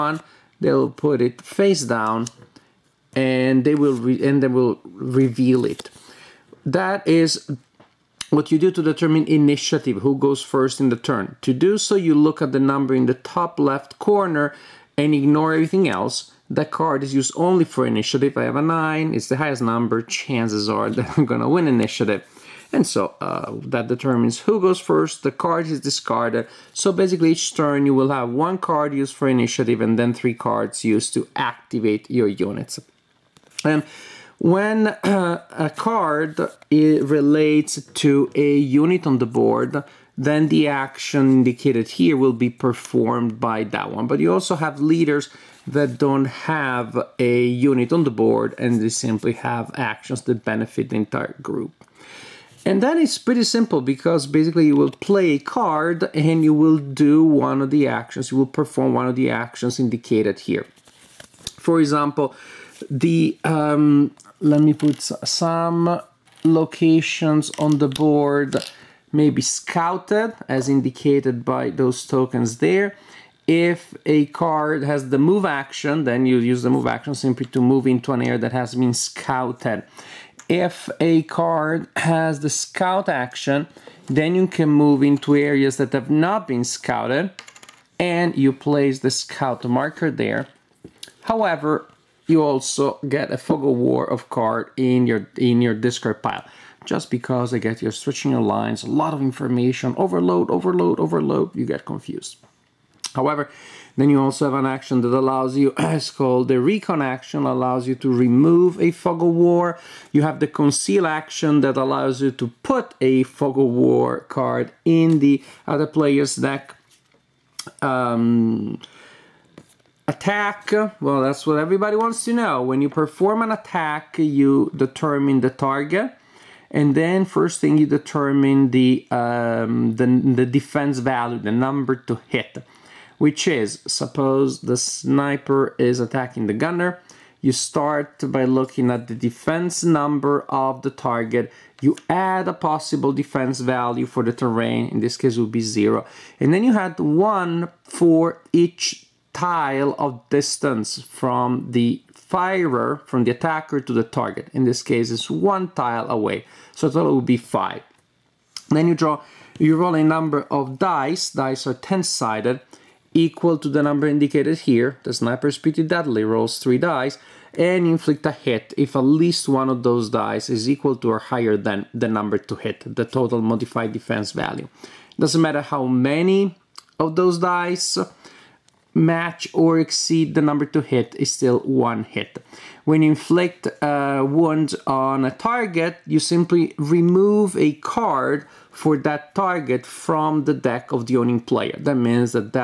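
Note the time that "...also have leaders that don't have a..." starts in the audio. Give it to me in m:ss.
0:44.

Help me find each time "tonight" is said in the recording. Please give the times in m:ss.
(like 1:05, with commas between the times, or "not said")
not said.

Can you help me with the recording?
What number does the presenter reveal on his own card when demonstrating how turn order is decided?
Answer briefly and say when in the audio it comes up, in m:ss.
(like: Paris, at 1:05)
9, at 0:18.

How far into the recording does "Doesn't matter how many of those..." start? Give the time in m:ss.
2:55.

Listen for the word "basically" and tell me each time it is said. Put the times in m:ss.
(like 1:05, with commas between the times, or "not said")
0:26, 0:54.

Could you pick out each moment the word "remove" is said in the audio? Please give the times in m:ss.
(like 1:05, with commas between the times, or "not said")
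1:48, 3:06.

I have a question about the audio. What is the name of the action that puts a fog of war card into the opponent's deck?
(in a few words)
Conceal.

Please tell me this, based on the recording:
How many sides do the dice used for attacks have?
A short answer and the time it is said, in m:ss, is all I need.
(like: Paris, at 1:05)
10, at 2:41.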